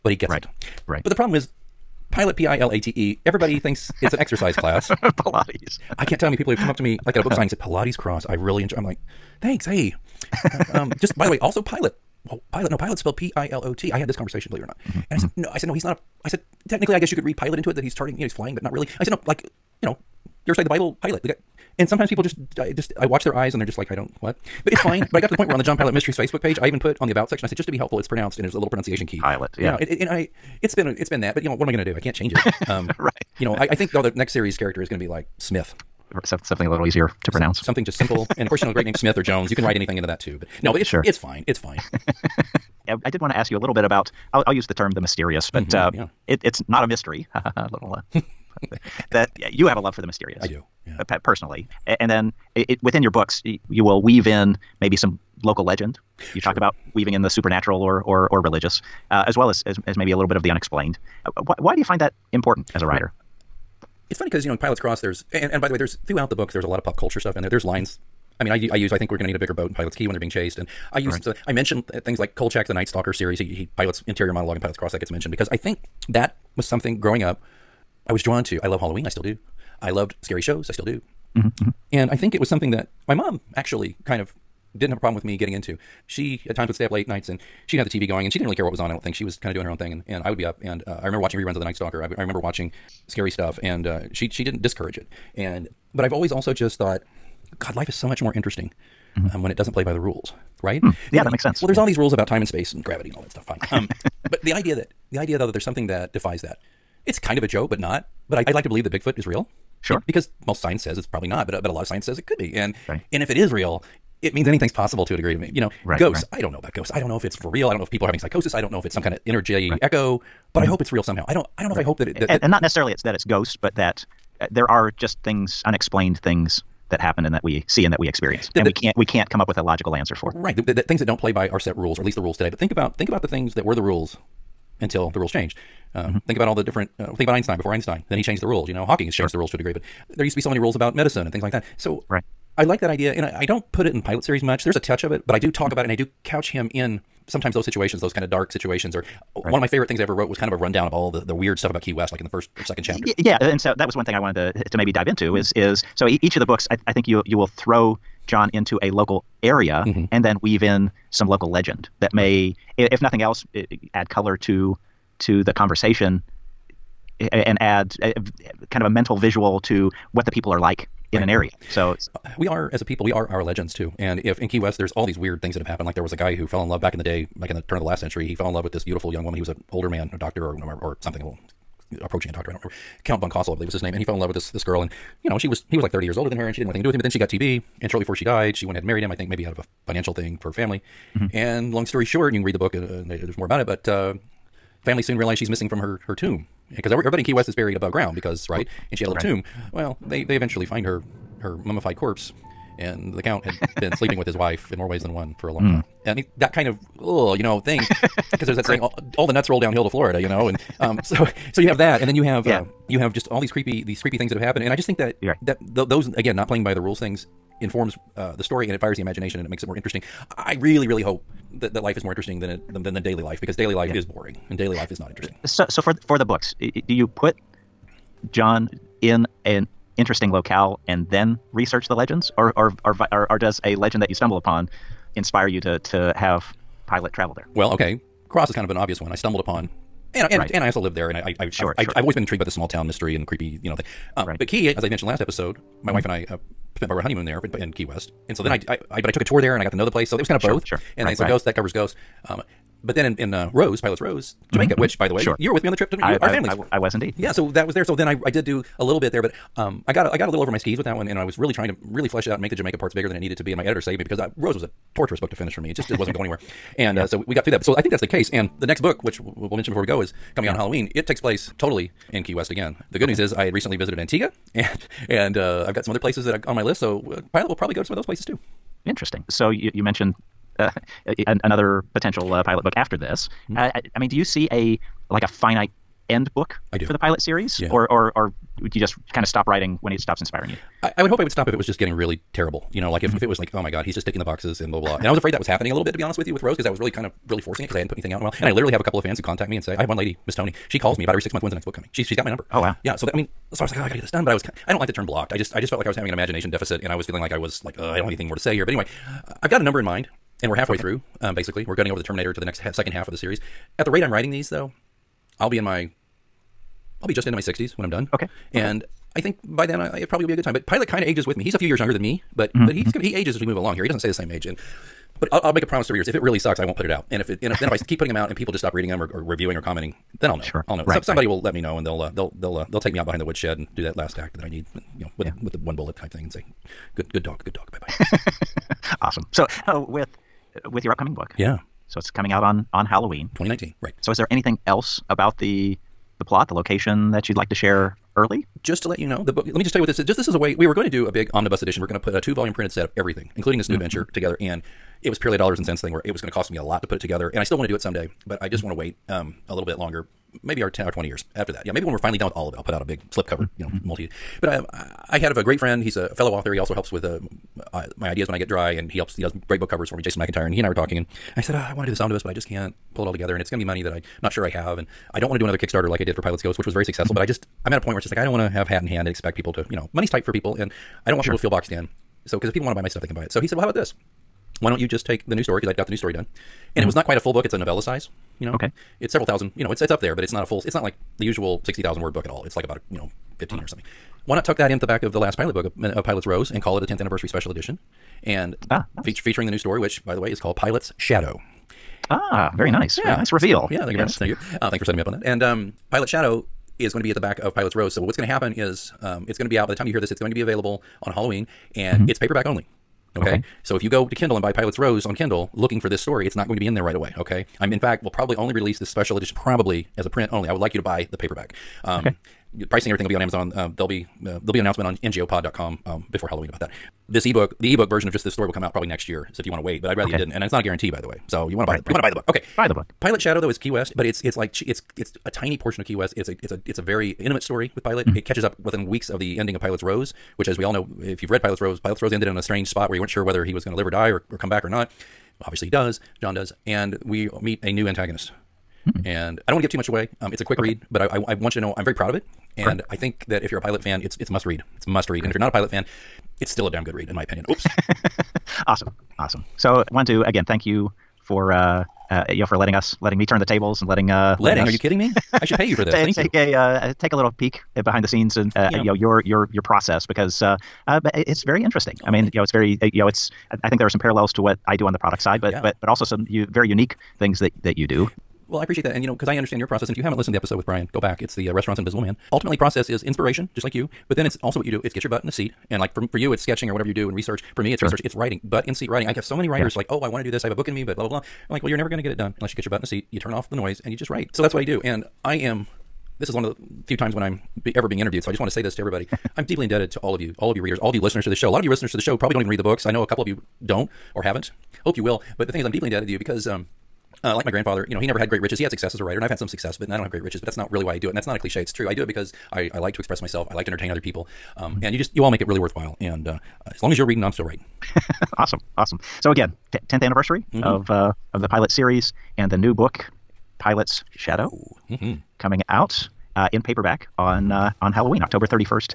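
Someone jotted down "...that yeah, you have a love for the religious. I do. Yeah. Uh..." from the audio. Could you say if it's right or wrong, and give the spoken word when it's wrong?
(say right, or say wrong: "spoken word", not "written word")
wrong: "mysterious", not "religious".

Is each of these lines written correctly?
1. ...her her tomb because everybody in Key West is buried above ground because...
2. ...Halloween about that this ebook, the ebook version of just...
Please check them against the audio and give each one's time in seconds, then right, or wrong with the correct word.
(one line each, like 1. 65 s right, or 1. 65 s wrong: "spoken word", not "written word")
1. 195 s right
2. 426 s right.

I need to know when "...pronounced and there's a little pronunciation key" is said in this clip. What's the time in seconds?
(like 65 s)
28 s.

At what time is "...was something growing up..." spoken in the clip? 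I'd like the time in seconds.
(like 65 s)
76 s.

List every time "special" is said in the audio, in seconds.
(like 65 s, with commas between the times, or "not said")
397 s, 418 s.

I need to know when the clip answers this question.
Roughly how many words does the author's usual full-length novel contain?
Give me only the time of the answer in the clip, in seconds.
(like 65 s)
391 s.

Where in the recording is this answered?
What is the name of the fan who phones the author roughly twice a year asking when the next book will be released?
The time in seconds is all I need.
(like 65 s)
300 s.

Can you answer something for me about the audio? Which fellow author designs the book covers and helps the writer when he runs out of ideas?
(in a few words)
Jason McIntyre.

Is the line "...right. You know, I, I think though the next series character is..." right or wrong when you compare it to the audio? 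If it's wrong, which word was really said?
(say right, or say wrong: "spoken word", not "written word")
right.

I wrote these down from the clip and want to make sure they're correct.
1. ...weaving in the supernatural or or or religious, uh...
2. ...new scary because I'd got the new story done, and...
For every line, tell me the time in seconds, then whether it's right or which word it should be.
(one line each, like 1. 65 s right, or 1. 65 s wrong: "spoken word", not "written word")
1. 56 s right
2. 385 s wrong: "story", not "scary".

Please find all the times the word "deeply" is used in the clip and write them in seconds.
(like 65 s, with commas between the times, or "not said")
499 s, 505 s.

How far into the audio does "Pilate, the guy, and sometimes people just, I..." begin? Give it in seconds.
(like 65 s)
21 s.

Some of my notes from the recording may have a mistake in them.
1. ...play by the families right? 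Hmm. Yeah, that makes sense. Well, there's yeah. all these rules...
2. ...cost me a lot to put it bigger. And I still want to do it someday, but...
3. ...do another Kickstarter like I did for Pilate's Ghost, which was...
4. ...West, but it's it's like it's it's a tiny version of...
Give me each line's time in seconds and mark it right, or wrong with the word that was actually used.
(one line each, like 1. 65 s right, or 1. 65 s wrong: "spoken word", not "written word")
1. 99 s wrong: "rules", not "families"
2. 356 s wrong: "together", not "bigger"
3. 375 s right
4. 433 s wrong: "portion", not "version".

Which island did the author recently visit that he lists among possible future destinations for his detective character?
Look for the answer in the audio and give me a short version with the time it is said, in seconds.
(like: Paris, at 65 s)
Antigua, at 273 s.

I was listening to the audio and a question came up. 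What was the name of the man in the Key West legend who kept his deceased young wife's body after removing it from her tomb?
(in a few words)
Count von Cosel.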